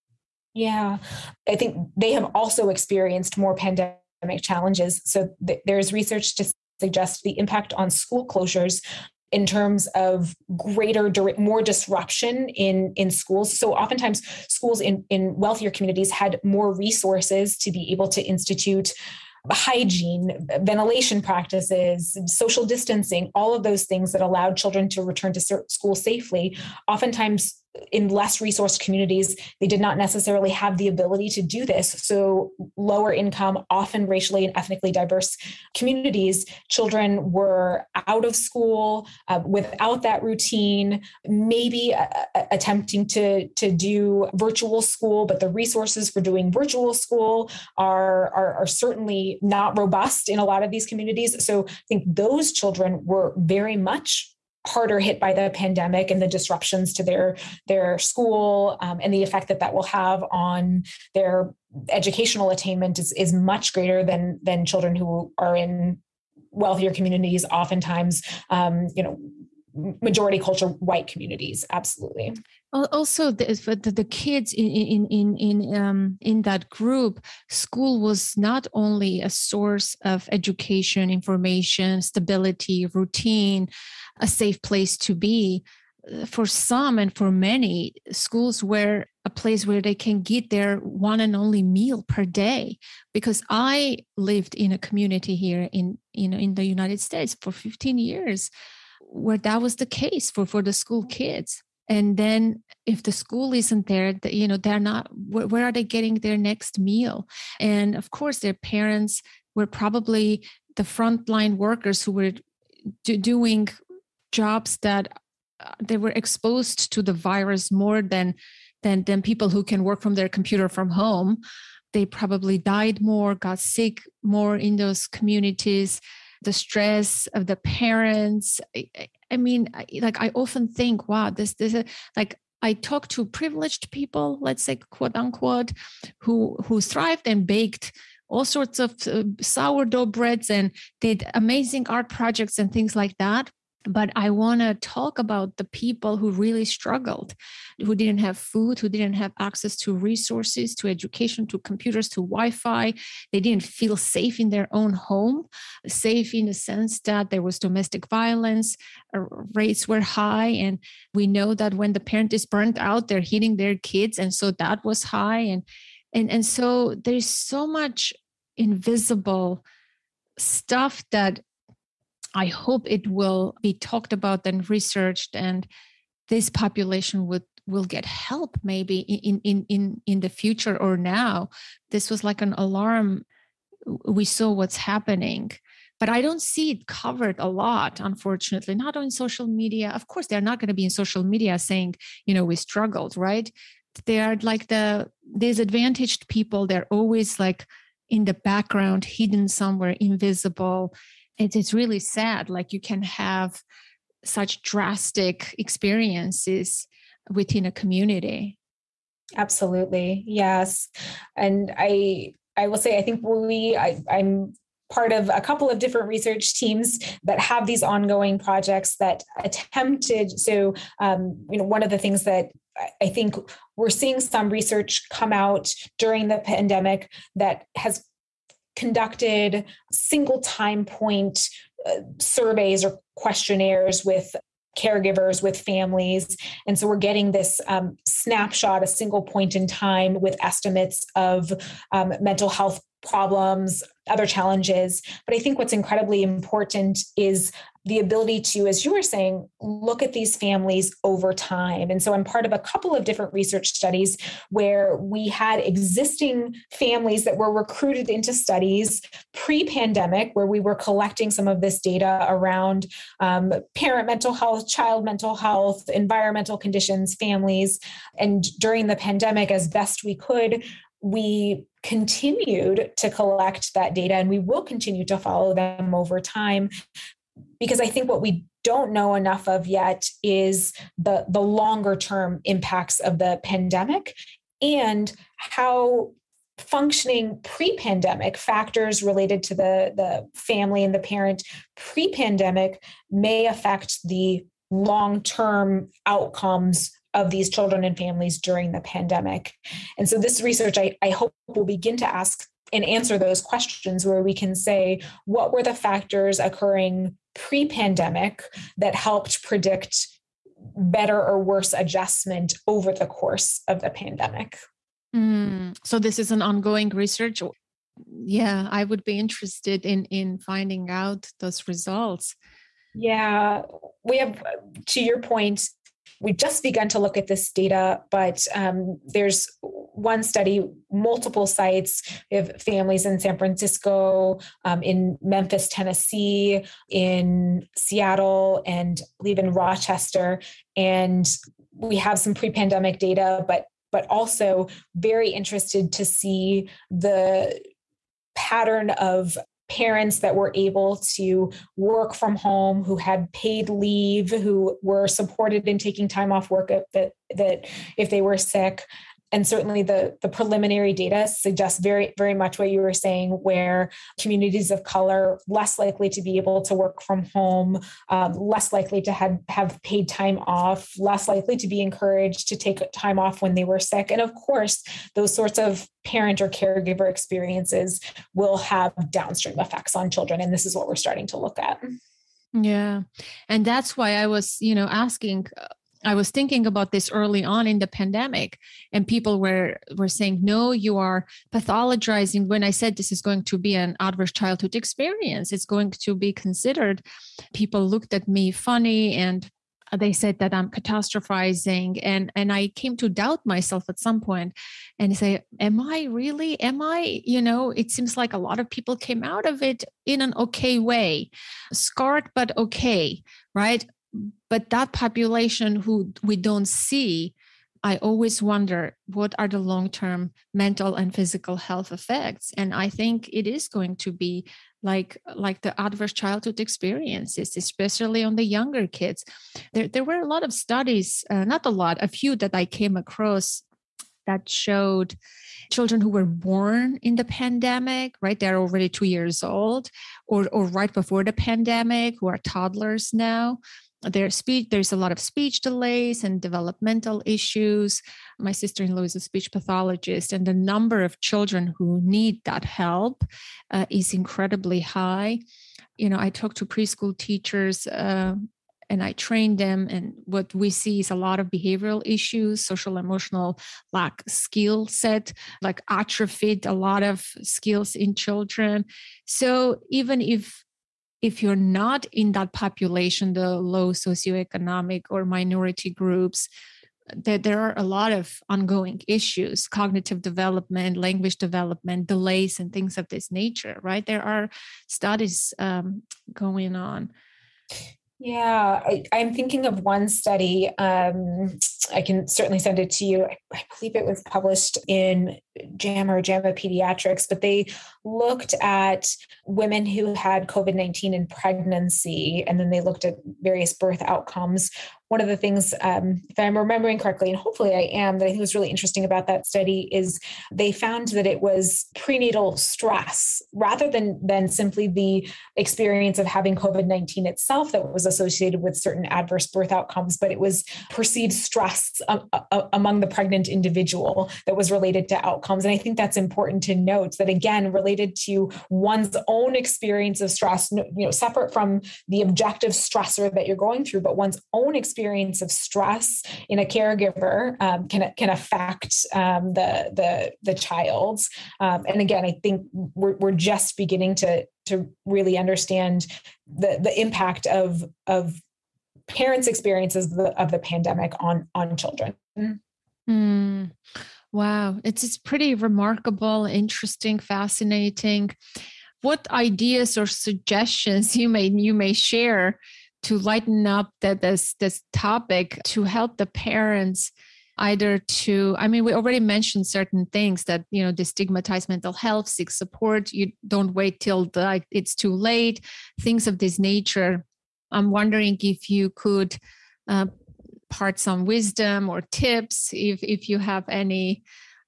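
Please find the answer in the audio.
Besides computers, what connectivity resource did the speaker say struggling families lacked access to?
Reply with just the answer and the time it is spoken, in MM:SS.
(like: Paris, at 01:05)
Wi Fi, at 02:32.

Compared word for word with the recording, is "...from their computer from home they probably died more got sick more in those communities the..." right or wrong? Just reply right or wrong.
right.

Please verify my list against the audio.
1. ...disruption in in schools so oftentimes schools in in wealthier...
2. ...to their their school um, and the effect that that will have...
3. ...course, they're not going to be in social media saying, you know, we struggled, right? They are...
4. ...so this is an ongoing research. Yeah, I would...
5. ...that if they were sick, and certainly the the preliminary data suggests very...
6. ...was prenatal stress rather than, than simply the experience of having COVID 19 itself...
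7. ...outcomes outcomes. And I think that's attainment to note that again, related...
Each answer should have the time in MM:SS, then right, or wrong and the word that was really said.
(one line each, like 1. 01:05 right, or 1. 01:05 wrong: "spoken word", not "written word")
1. 00:11 right
2. 00:56 right
3. 03:10 right
4. 05:15 right
5. 05:57 right
6. 08:31 right
7. 08:45 wrong: "important", not "attainment".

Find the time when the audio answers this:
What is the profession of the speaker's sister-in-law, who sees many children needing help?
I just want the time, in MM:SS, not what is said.
07:29.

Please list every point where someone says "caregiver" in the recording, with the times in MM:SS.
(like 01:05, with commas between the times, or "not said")
03:54, 06:16, 08:56.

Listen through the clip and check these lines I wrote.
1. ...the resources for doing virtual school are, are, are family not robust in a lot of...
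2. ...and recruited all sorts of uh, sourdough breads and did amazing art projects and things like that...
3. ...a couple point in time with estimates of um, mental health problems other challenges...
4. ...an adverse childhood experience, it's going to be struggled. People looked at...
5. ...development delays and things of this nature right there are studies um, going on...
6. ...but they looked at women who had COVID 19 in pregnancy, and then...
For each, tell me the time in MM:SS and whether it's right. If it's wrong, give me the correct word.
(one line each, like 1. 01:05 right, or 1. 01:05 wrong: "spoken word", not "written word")
1. 00:45 wrong: "certainly", not "family"
2. 02:17 wrong: "baked", not "recruited"
3. 03:58 wrong: "single", not "couple"
4. 06:33 wrong: "considered", not "struggled"
5. 08:01 right
6. 08:17 right.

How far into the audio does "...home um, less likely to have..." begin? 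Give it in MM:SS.
06:07.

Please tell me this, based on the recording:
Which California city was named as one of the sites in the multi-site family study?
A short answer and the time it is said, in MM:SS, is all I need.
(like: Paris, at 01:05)
San Francisco, at 05:33.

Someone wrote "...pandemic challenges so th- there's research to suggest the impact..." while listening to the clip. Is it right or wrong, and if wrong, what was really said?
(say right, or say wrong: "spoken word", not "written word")
right.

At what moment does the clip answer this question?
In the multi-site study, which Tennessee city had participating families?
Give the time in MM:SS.
05:35.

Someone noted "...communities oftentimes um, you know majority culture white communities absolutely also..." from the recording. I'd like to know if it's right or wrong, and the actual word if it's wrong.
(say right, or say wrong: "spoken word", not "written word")
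right.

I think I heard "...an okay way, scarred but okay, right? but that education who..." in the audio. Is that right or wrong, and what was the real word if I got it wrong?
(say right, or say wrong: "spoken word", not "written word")
wrong: "population", not "education".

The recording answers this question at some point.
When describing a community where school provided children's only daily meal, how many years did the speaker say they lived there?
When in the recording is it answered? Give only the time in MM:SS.
01:37.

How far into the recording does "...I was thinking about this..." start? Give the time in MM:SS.
06:26.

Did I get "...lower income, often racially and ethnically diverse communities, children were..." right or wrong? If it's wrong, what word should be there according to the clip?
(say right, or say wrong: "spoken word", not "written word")
right.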